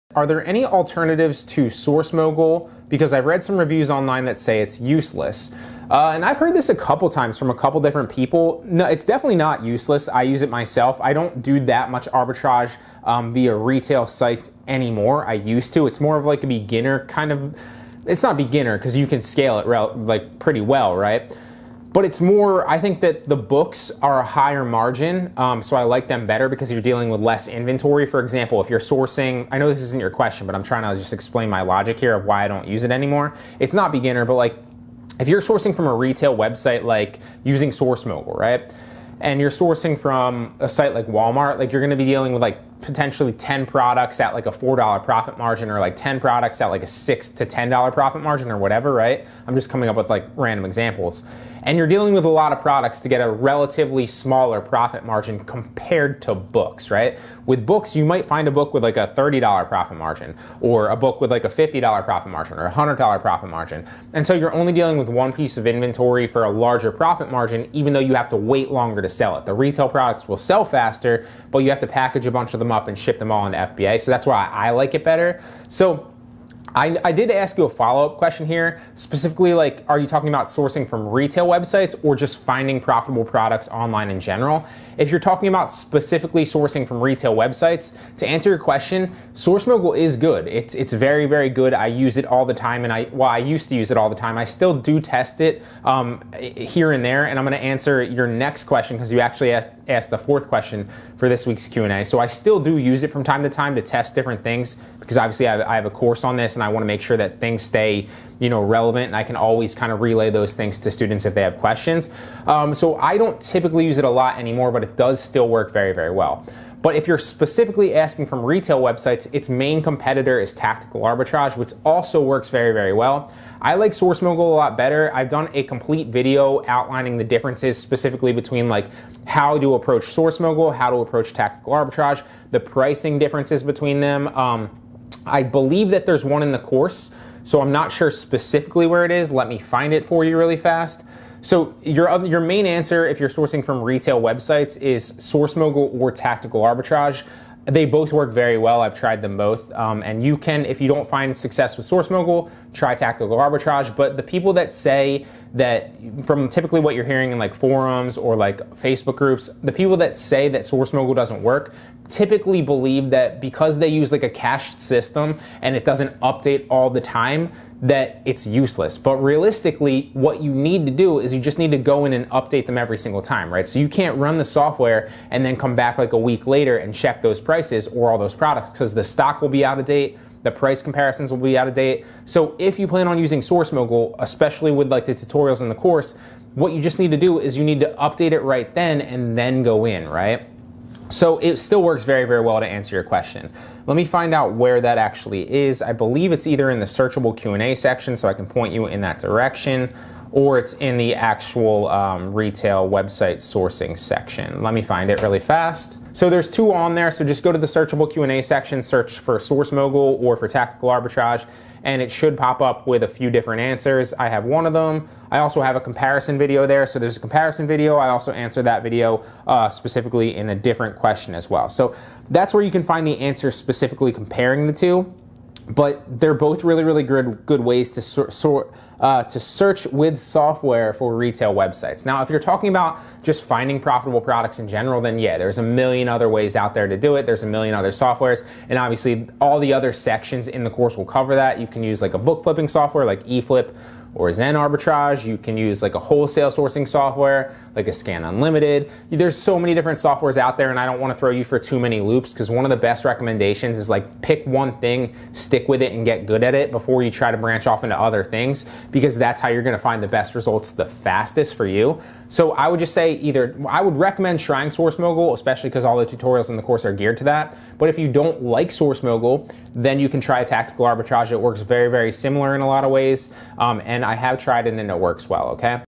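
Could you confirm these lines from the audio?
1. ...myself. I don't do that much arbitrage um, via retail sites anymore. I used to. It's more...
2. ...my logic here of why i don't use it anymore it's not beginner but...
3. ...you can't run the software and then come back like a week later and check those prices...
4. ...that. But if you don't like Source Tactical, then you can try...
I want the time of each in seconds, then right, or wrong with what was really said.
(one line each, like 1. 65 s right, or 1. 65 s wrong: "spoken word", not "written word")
1. 10 s right
2. 31 s right
3. 173 s right
4. 267 s wrong: "Mogul", not "Tactical".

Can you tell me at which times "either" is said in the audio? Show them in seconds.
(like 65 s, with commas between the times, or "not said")
196 s, 263 s.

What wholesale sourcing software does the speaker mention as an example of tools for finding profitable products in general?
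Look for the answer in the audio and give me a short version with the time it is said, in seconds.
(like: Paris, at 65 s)
Scan Unlimited, at 247 s.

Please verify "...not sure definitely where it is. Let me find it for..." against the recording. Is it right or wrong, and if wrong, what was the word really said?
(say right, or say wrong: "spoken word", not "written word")
wrong: "specifically", not "definitely".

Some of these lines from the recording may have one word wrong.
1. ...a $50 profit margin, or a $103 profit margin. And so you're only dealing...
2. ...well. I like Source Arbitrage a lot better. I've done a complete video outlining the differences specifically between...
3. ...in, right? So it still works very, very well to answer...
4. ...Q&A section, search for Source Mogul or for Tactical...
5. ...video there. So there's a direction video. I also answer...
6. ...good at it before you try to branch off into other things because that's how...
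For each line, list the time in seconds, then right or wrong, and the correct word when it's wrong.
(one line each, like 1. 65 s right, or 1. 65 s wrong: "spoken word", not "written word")
1. 61 s wrong: "100", not "103"
2. 122 s wrong: "Mogul", not "Arbitrage"
3. 189 s right
4. 208 s right
5. 216 s wrong: "comparison", not "direction"
6. 256 s right.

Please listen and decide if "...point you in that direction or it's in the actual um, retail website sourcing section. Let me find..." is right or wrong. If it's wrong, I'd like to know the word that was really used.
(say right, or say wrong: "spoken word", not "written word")
right.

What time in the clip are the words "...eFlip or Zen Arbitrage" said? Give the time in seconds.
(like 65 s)
243 s.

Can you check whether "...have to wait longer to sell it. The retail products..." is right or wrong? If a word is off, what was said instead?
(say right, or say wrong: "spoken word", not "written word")
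right.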